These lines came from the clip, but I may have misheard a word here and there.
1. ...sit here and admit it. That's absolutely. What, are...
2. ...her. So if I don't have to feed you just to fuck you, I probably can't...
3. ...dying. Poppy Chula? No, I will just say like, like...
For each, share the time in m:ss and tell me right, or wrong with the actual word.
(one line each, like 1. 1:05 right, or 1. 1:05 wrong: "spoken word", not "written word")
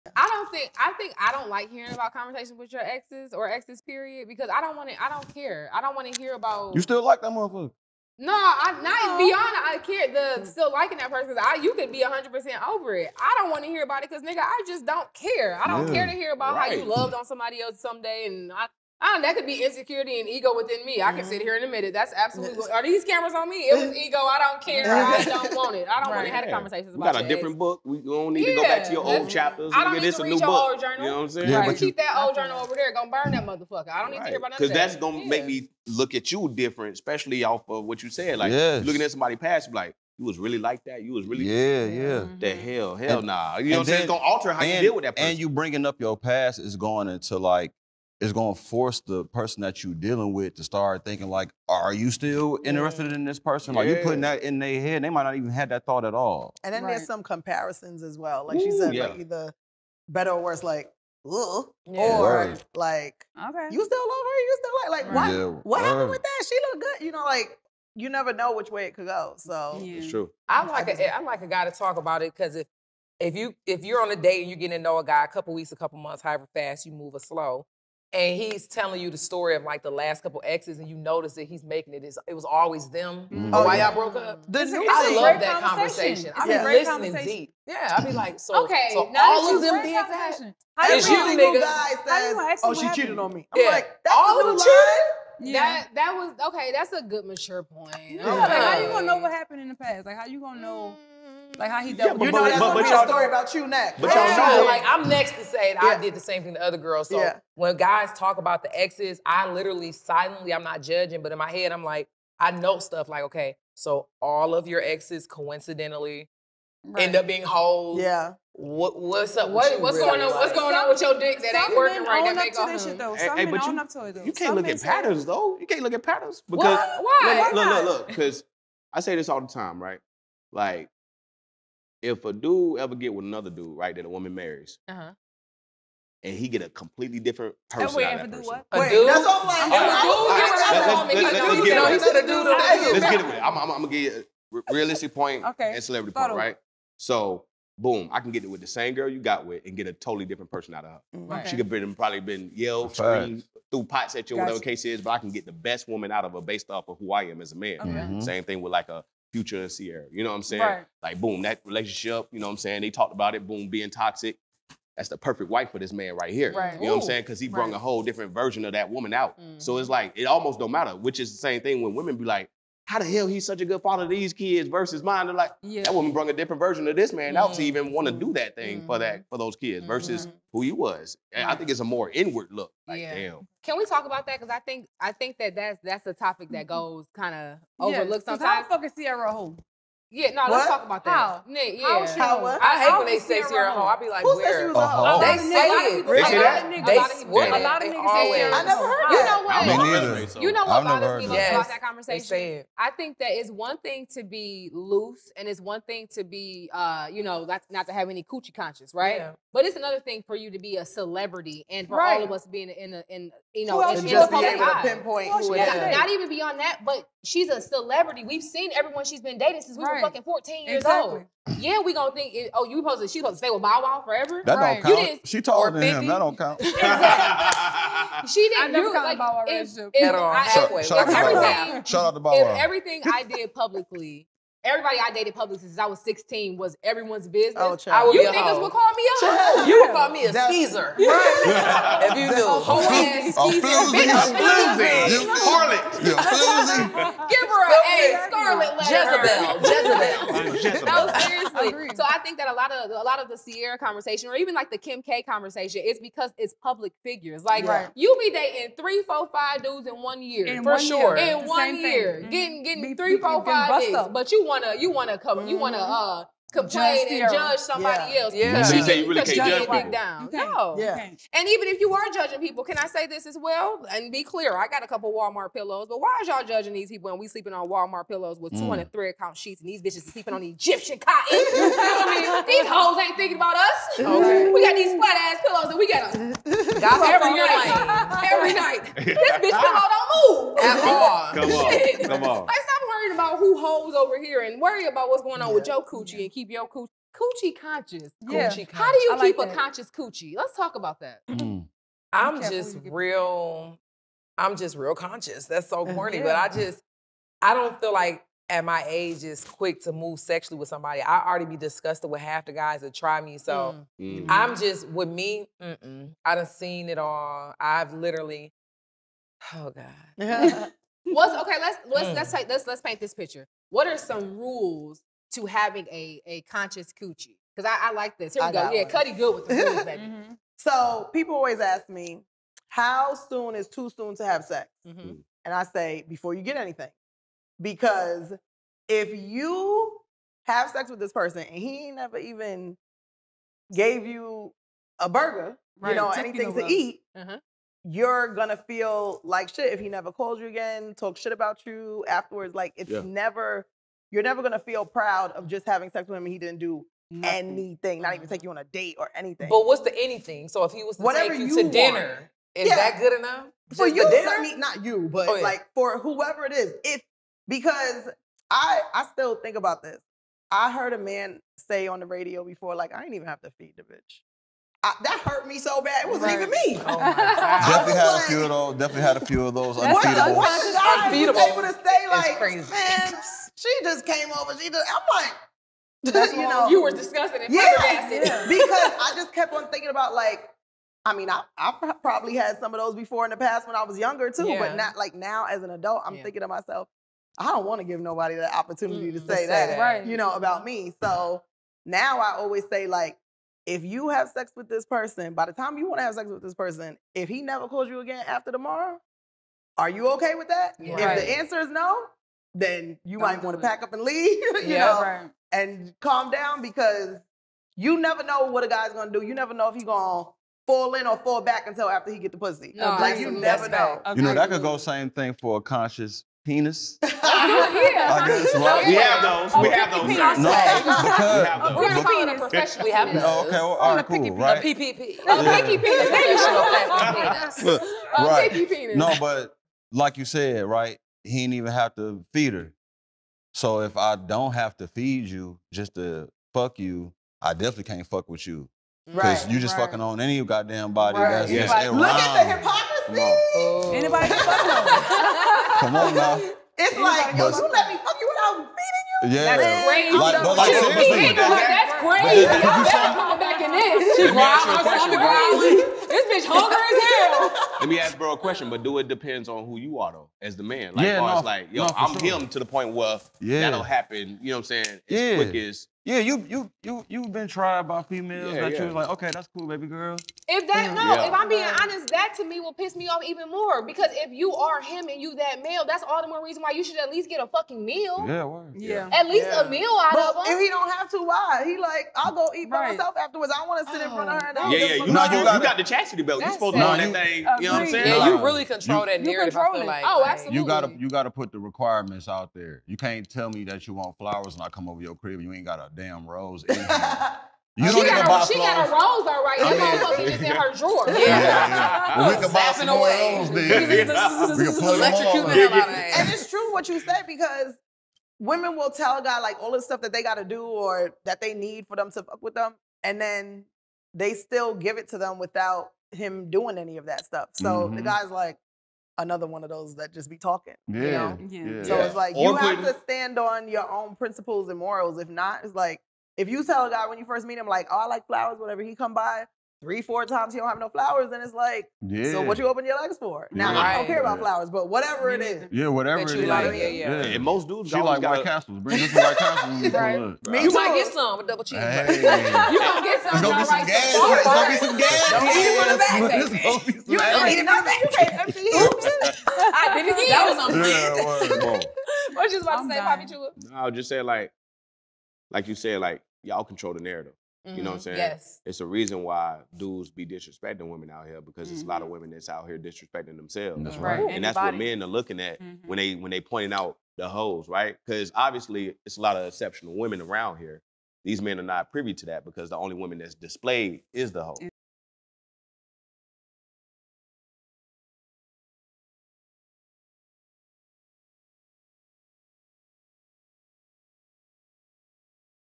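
1. 0:21 right
2. 7:22 wrong: "definitely", not "probably"
3. 9:22 right.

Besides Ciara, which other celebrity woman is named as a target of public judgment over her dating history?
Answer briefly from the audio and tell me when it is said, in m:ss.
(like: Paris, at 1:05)
Kim K, at 4:14.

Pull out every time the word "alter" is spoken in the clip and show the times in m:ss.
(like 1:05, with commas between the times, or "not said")
0:44.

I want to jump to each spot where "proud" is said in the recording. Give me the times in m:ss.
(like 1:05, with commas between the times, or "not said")
5:54.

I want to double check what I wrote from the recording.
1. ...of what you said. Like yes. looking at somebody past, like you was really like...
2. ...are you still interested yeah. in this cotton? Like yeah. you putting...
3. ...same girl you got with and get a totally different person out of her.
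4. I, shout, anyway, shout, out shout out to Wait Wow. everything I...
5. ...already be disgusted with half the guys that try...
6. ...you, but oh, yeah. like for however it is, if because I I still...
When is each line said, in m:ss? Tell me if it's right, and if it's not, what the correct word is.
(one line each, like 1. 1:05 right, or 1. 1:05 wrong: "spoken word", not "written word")
1. 0:37 right
2. 0:51 wrong: "person", not "cotton"
3. 2:28 right
4. 3:50 wrong: "Bow", not "Wait"
5. 5:11 right
6. 6:04 wrong: "whoever", not "however".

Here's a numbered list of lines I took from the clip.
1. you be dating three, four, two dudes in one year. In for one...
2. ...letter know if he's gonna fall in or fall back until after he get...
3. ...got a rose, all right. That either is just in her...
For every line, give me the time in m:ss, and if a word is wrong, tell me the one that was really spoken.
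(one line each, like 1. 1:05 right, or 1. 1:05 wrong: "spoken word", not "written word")
1. 4:17 wrong: "five", not "two"
2. 6:59 wrong: "never", not "letter"
3. 8:28 wrong: "motherfucker", not "either".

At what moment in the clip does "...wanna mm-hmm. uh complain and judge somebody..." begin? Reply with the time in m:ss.
4:25.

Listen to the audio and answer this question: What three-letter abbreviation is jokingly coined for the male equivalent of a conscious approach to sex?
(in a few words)
PPP.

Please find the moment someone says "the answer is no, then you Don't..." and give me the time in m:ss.
6:51.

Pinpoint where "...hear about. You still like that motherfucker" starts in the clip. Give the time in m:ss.
0:06.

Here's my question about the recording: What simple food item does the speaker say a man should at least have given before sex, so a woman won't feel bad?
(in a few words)
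A burger.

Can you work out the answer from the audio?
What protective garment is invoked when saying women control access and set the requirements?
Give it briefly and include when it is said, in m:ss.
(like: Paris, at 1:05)
Chastity belt, at 8:15.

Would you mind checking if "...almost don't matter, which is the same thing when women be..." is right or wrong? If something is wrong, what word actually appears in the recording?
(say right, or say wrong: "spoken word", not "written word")
right.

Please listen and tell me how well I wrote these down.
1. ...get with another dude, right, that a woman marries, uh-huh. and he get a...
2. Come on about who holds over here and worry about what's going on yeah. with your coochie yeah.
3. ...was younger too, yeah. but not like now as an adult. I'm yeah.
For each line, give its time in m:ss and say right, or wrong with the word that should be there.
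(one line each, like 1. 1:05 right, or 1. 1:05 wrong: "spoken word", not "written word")
1. 2:12 right
2. 4:52 right
3. 6:33 right.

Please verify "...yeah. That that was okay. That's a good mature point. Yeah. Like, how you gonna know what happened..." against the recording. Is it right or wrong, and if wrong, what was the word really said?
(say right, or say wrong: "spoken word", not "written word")
right.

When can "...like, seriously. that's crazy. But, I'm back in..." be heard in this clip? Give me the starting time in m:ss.
7:40.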